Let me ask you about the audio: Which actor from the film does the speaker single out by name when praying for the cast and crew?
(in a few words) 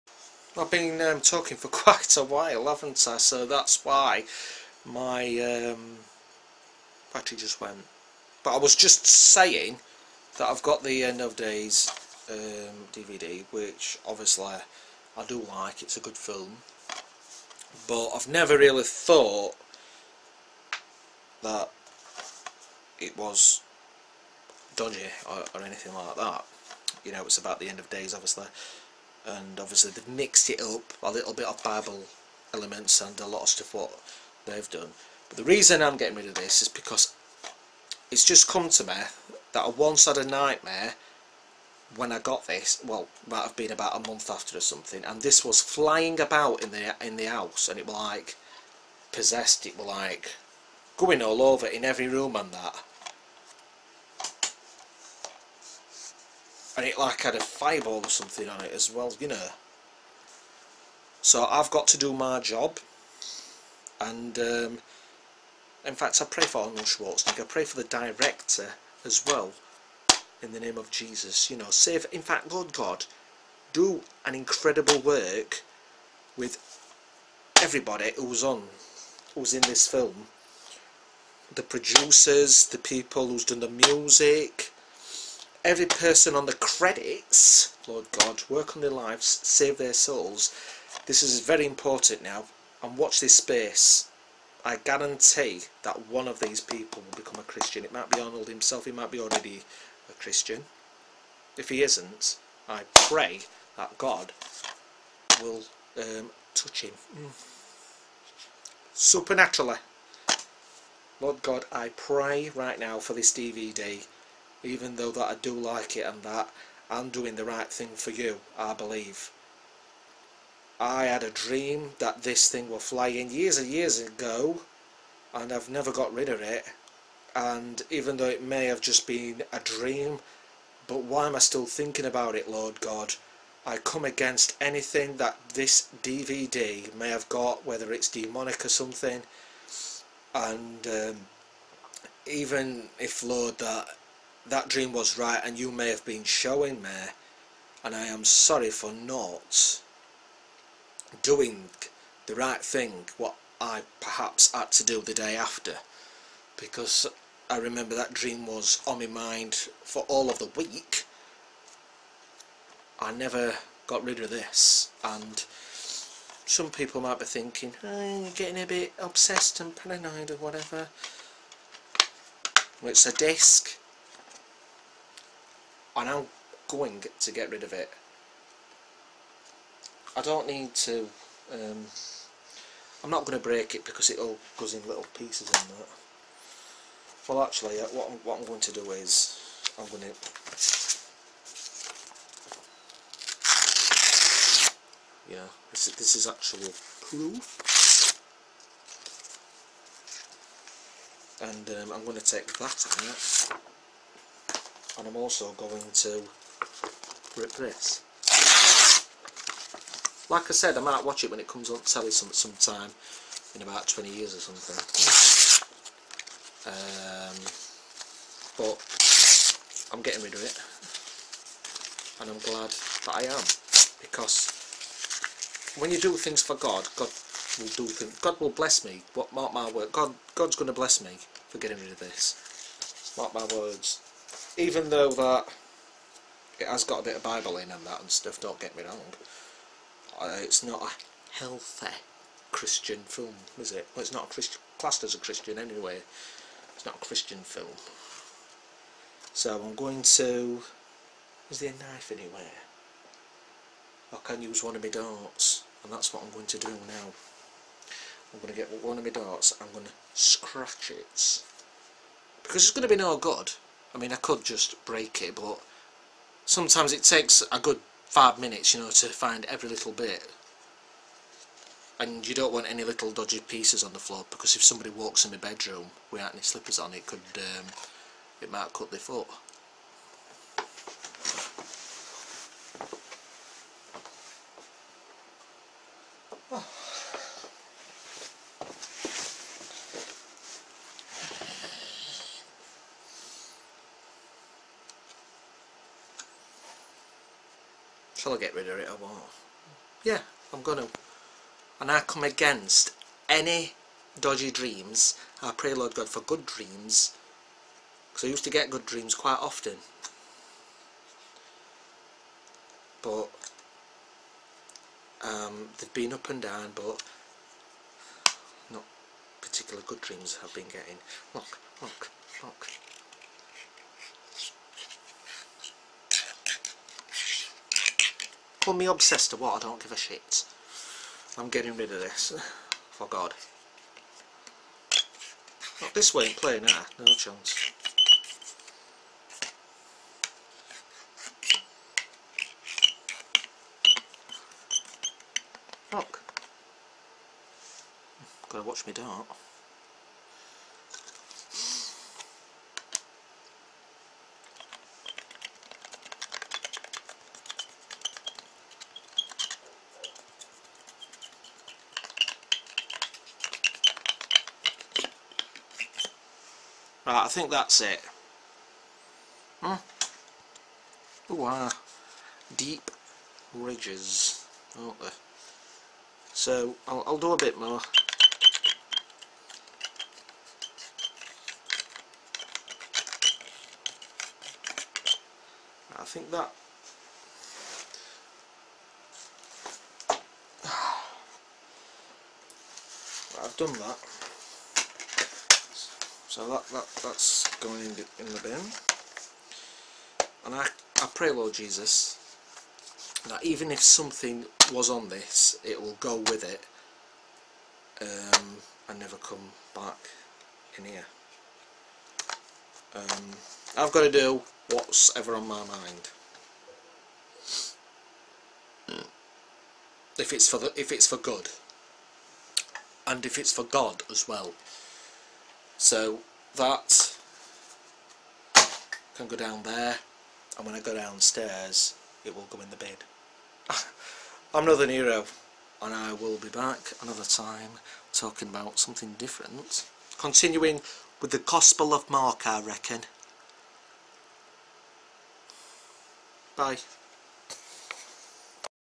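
Arnold Schwarzenegger.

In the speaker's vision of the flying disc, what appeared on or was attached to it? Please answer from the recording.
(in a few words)
a fireball.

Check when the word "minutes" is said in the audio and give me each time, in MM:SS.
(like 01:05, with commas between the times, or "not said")
04:28.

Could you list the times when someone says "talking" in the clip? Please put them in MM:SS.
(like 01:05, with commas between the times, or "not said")
00:01, 07:18.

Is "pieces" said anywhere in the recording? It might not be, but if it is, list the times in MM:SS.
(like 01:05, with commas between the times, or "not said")
03:05, 04:33.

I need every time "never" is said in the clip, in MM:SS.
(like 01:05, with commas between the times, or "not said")
00:18, 02:05, 02:43, 06:48.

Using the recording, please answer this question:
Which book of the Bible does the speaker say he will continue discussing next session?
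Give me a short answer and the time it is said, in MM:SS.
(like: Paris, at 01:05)
Gospel of Mark, at 07:21.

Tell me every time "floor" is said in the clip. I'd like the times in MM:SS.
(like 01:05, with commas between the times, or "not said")
04:33.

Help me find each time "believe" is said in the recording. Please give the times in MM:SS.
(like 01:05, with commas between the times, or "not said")
01:58.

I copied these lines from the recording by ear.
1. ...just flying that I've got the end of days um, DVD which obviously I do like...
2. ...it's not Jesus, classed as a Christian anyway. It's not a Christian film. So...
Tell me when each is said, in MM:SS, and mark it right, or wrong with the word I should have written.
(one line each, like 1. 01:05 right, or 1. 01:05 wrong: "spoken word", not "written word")
1. 00:08 wrong: "saying", not "flying"
2. 04:04 wrong: "Christian", not "Jesus".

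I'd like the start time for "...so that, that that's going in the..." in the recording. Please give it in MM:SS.
06:36.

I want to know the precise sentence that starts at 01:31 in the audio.
This is very important now, and watch this space.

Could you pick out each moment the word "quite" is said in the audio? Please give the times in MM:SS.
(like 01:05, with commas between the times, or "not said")
00:01, 05:09.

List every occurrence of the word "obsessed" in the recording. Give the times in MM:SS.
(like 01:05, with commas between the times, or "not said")
02:48, 05:28.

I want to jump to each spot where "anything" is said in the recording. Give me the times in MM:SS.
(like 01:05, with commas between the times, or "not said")
00:25, 02:14.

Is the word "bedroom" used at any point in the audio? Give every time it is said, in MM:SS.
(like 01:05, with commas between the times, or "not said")
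04:35.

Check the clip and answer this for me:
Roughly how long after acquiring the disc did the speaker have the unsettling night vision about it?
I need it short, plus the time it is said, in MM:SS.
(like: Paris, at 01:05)
about a month, at 00:43.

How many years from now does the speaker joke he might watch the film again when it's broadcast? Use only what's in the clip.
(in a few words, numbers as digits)
20.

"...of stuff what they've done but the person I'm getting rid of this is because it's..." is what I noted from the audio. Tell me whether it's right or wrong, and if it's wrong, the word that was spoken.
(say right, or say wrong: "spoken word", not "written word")
wrong: "reason", not "person".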